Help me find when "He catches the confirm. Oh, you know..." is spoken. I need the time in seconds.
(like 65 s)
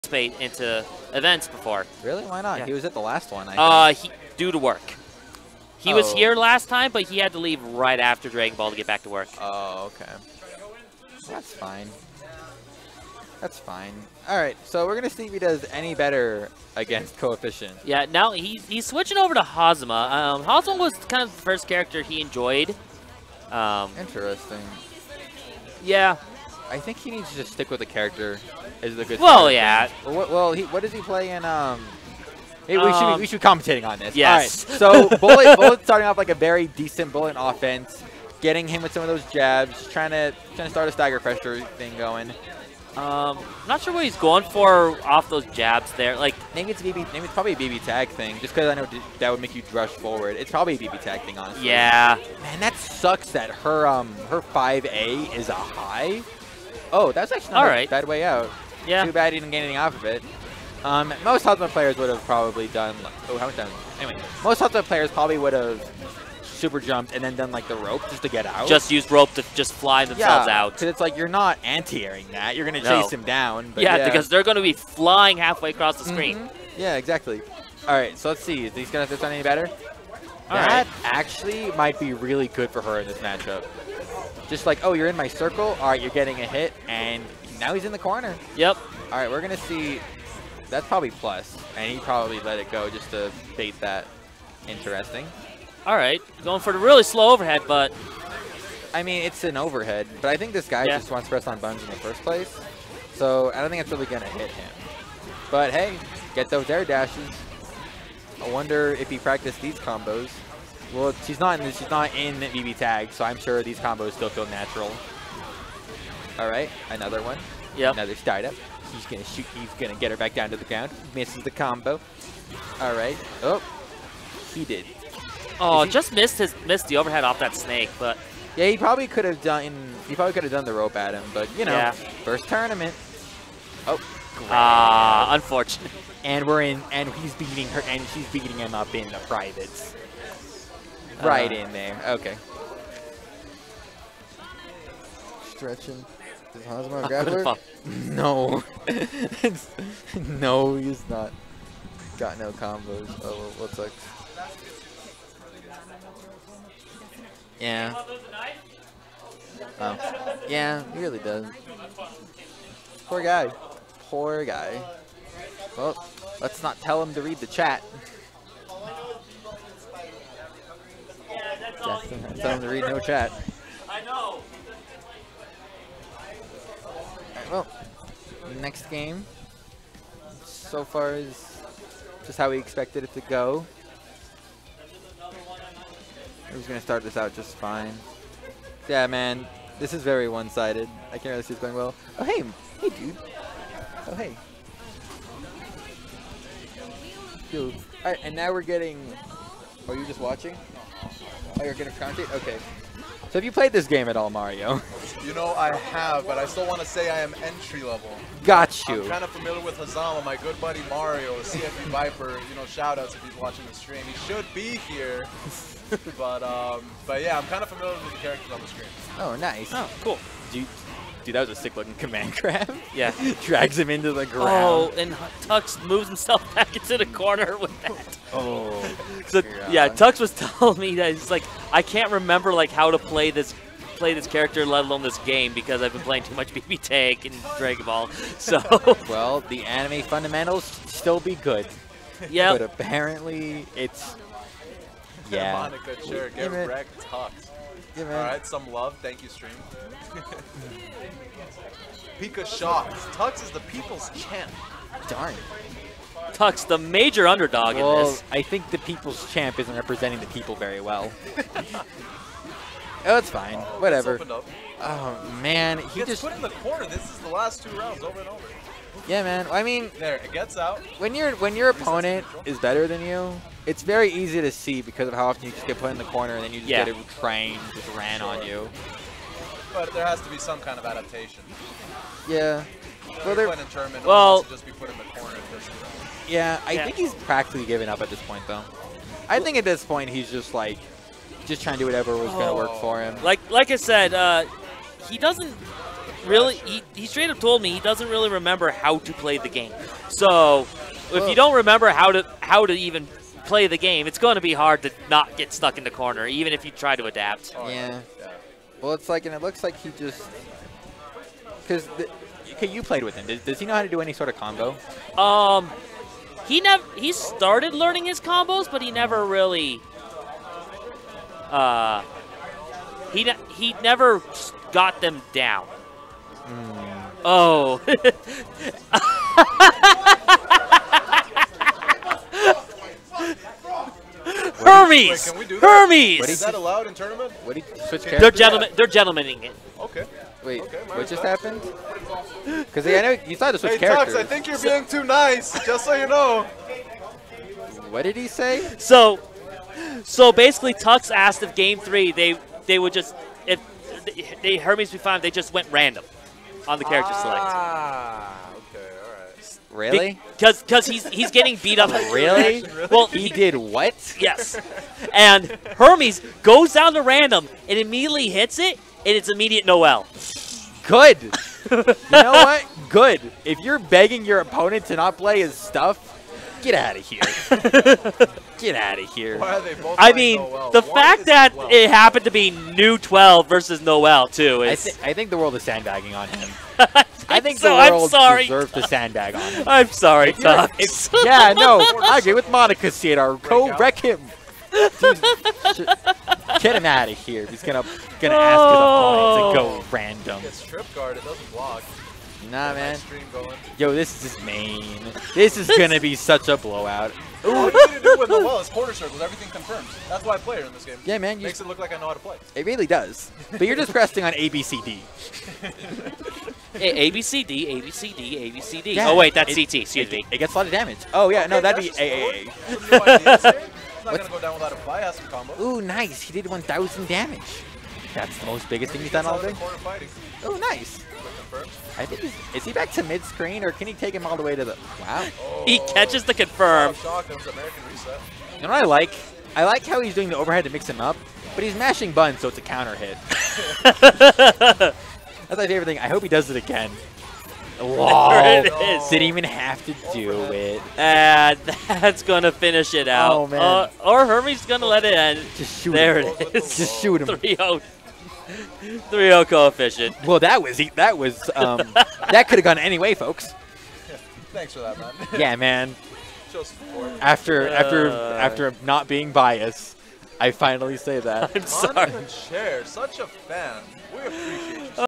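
435 s.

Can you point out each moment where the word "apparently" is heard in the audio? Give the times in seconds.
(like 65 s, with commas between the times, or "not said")
242 s.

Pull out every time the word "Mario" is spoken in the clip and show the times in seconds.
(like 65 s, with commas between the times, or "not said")
204 s, 210 s.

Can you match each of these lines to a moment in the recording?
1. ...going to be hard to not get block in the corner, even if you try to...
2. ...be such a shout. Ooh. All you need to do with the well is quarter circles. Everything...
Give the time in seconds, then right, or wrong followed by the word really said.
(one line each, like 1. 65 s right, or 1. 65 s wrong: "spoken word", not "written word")
1. 304 s wrong: "stuck", not "block"
2. 405 s wrong: "blowout", not "shout".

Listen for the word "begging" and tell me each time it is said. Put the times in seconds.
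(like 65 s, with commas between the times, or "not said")
373 s.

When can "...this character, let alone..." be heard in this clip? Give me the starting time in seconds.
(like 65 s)
234 s.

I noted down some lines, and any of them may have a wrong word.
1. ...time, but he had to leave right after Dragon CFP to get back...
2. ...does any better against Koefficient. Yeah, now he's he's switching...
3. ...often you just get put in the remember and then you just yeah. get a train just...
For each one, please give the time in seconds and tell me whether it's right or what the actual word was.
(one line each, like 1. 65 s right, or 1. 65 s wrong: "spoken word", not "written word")
1. 6 s wrong: "Ball", not "CFP"
2. 15 s right
3. 275 s wrong: "corner", not "remember".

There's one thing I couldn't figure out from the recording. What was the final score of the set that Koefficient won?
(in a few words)
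3-0.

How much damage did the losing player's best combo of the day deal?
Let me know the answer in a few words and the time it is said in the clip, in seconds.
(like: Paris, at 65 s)
1,000, at 426 s.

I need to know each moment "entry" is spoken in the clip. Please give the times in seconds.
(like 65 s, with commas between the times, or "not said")
207 s.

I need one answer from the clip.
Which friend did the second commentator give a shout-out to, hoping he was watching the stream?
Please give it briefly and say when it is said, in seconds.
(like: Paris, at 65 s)
CFP Viper, at 211 s.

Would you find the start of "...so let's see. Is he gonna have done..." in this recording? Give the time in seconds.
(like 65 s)
78 s.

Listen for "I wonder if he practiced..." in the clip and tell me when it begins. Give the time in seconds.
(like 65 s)
108 s.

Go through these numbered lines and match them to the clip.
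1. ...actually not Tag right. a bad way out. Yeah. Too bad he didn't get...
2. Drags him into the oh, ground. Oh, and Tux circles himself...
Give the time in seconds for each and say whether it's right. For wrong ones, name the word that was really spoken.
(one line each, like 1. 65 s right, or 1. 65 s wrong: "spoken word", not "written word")
1. 57 s wrong: "All", not "Tag"
2. 223 s wrong: "moves", not "circles".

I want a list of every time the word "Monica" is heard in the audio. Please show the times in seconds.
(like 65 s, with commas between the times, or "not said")
245 s, 392 s.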